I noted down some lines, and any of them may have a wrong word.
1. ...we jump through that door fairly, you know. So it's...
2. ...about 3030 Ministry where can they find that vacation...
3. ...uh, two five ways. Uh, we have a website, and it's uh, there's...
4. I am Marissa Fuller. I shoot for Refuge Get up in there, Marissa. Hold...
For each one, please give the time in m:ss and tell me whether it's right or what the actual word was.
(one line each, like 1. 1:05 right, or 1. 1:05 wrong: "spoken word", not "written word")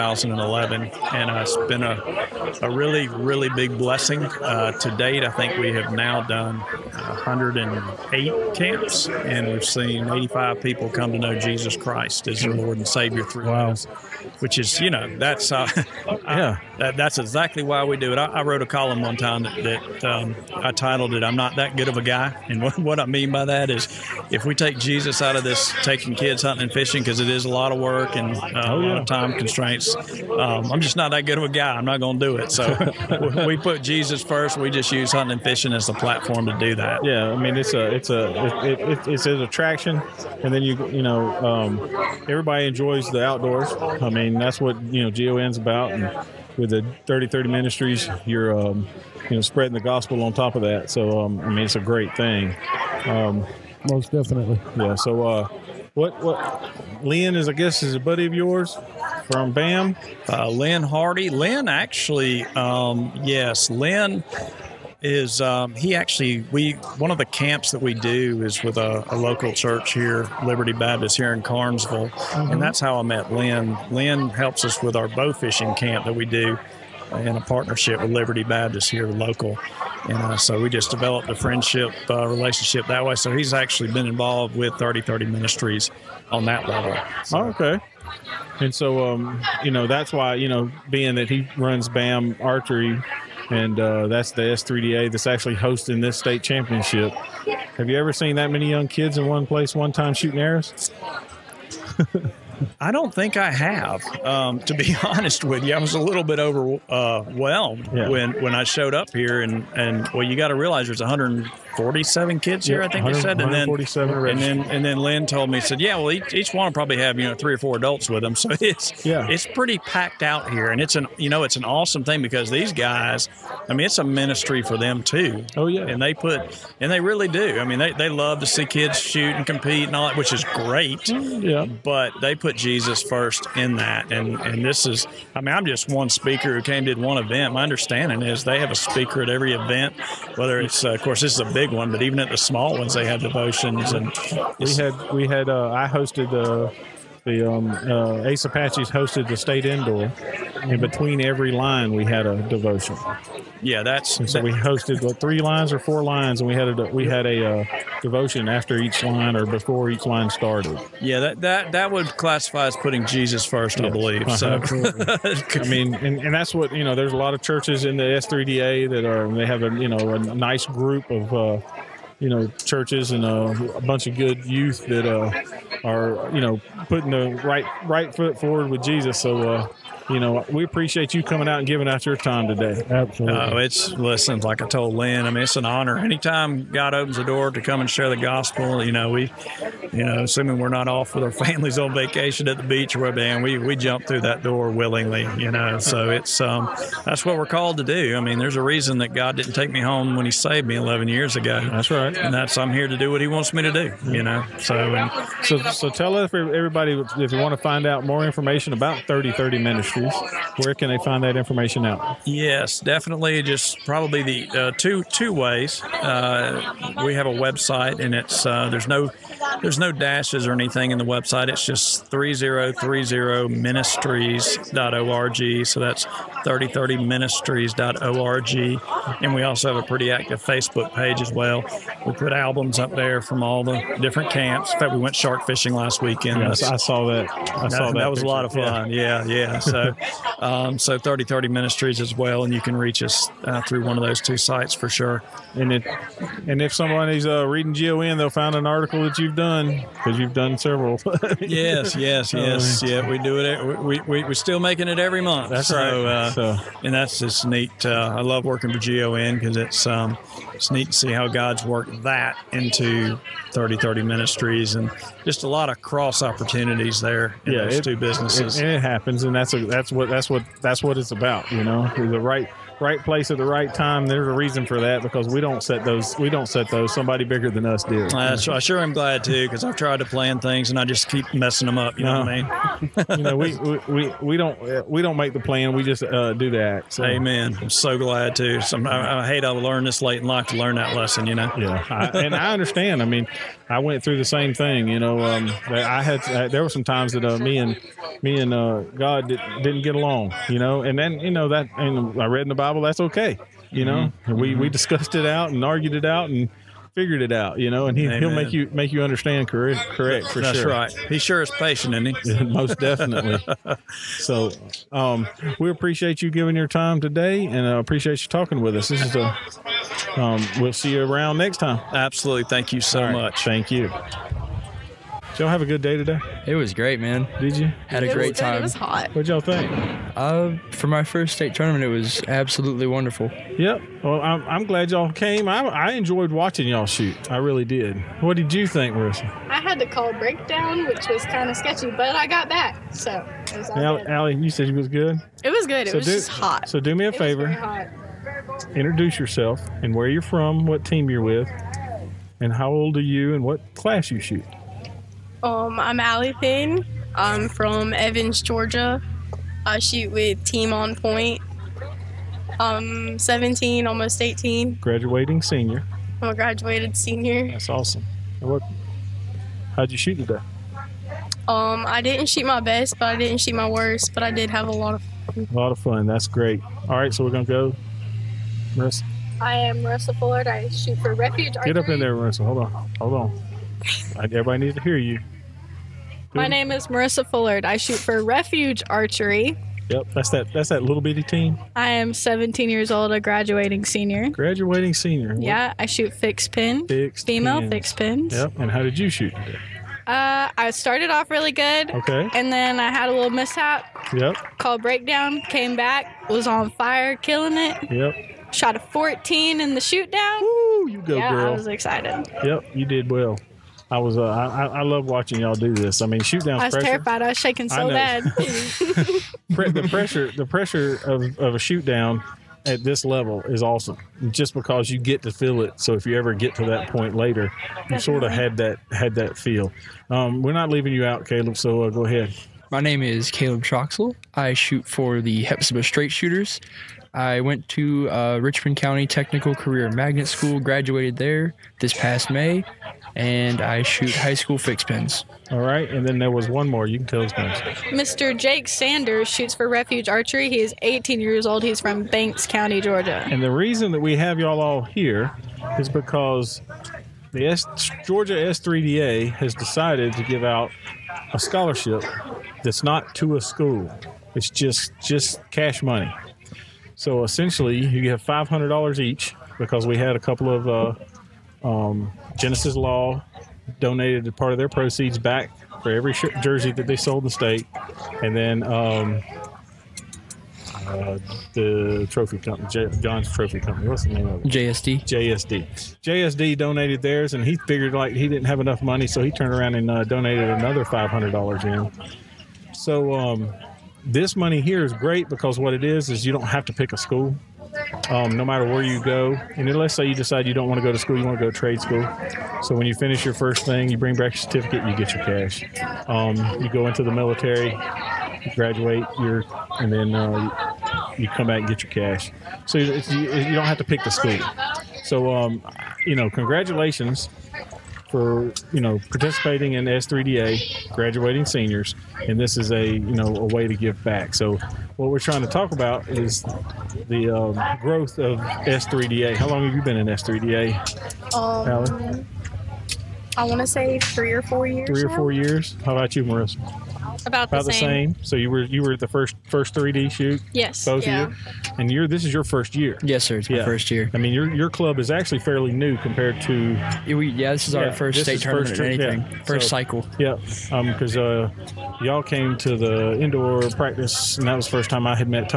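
1. 3:13 wrong: "willingly", not "fairly"
2. 3:28 wrong: "information", not "vacation"
3. 3:34 wrong: "two", not "five"
4. 6:19 right.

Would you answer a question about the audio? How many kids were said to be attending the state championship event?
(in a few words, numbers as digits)
147.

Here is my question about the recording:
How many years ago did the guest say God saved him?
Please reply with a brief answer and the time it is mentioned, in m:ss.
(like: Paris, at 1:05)
11, at 3:20.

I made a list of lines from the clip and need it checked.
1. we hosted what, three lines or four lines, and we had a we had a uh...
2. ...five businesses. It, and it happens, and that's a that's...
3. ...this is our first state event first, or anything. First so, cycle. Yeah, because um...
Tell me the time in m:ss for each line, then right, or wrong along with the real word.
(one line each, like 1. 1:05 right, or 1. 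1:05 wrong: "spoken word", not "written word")
1. 2:34 right
2. 4:27 wrong: "two", not "five"
3. 9:07 wrong: "tournament", not "event".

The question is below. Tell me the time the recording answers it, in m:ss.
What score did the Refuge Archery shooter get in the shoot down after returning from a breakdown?
6:48.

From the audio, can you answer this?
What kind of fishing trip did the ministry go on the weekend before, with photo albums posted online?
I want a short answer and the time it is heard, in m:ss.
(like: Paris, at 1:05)
Shark fishing, at 3:55.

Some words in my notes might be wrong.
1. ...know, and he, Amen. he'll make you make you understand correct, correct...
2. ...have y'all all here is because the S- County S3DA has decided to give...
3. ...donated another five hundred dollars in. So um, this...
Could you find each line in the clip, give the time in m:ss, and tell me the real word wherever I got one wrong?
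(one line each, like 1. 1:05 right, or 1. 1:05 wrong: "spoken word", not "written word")
1. 5:07 right
2. 7:34 wrong: "Georgia", not "County"
3. 8:10 right.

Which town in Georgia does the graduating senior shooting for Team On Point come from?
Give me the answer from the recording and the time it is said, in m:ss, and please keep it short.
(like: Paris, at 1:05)
Evans, at 5:57.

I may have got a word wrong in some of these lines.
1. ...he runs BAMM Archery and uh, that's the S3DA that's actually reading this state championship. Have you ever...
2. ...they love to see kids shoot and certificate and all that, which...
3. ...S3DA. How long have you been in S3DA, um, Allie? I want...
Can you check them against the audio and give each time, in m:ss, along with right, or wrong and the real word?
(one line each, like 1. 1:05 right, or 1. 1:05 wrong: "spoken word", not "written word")
1. 1:31 wrong: "hosting", not "reading"
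2. 2:07 wrong: "compete", not "certificate"
3. 8:48 right.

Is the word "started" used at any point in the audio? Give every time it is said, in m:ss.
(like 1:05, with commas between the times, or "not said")
2:40, 6:40.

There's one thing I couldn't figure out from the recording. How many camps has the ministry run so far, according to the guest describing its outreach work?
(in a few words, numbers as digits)
108.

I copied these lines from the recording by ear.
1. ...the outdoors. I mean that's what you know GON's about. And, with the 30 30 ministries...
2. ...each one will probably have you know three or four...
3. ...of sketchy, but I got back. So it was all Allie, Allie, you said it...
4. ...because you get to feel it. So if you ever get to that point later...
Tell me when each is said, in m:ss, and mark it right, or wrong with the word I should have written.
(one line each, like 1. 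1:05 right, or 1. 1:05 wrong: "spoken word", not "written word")
1. 0:43 right
2. 1:56 right
3. 5:41 right
4. 7:04 right.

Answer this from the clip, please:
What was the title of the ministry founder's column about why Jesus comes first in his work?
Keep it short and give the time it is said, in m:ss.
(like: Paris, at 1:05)
I'm Not That Good of a Guy, at 0:21.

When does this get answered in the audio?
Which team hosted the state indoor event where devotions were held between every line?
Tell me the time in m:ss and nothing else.
2:28.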